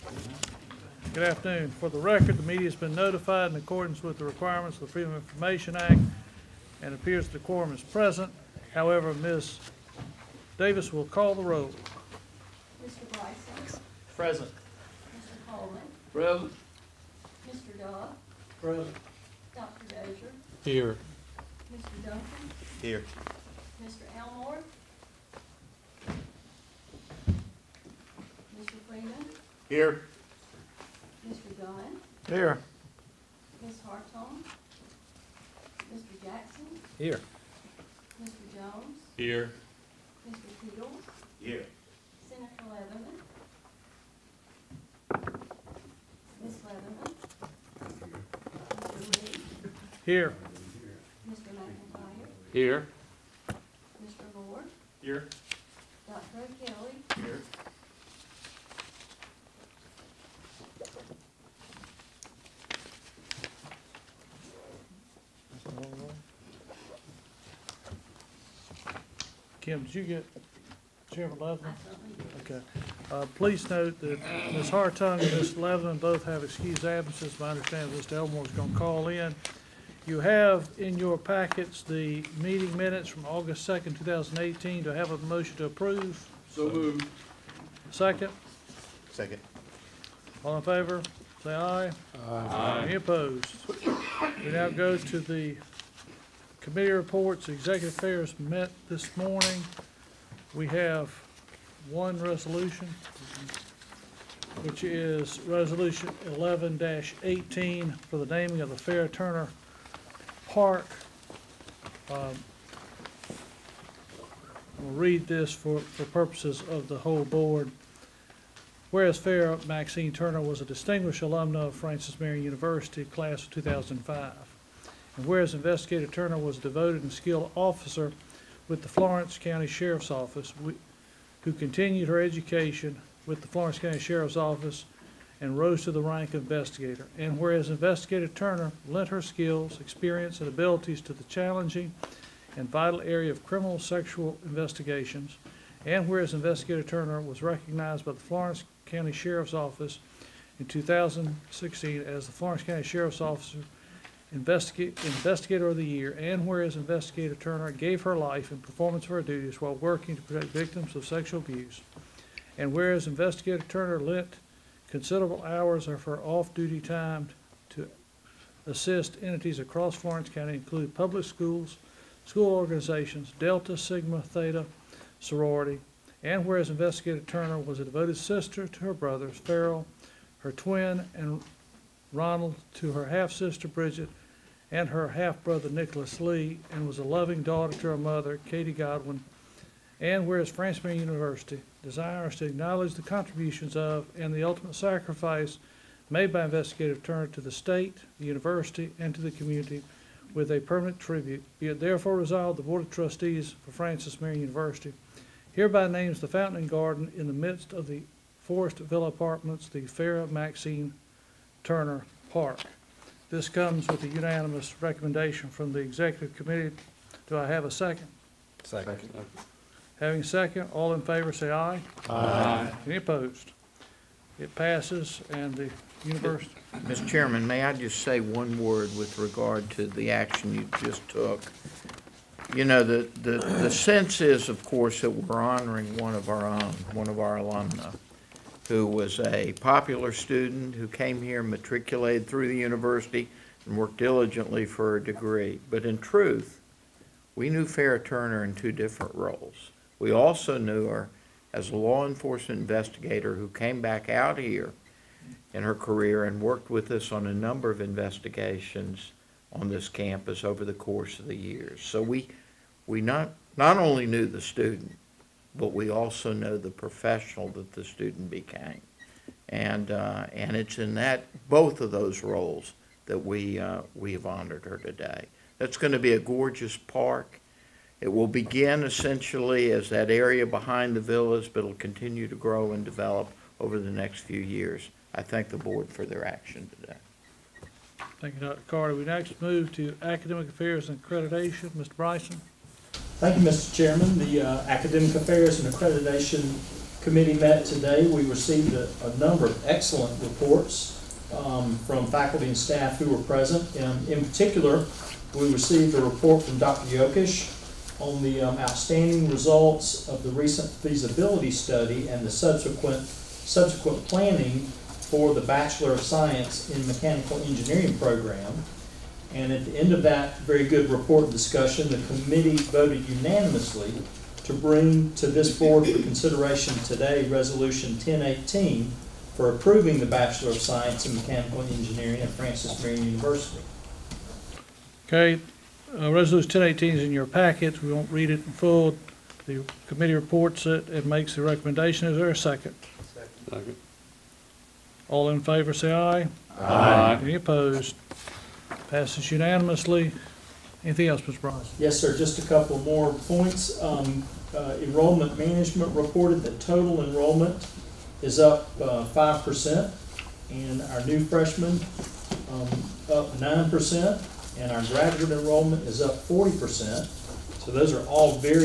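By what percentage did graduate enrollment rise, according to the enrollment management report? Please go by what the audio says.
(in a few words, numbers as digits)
40%.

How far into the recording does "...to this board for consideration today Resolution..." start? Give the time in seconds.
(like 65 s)
325 s.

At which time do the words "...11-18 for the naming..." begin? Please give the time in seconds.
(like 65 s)
106 s.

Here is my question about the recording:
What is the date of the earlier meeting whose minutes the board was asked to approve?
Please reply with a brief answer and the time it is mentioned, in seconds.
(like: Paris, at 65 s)
August 2nd, 2018, at 83 s.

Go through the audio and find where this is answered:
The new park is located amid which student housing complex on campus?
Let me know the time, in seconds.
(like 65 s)
208 s.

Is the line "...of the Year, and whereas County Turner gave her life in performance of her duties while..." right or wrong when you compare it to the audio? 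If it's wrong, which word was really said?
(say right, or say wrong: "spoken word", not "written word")
wrong: "Investigator", not "County".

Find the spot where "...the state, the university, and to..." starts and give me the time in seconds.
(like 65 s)
197 s.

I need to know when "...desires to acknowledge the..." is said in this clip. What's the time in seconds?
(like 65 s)
191 s.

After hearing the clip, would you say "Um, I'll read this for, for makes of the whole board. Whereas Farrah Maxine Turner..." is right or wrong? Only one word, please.
wrong.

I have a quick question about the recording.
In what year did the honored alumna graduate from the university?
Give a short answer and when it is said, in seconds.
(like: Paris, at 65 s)
2005, at 123 s.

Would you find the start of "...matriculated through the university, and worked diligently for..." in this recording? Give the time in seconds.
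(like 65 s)
241 s.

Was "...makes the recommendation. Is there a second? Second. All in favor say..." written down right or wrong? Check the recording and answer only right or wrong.
right.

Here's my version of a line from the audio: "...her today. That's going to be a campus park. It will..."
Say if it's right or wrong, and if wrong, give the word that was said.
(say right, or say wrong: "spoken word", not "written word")
wrong: "gorgeous", not "campus".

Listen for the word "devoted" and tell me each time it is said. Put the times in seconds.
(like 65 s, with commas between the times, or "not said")
126 s, 177 s.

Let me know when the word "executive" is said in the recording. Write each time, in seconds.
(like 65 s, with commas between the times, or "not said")
97 s, 215 s.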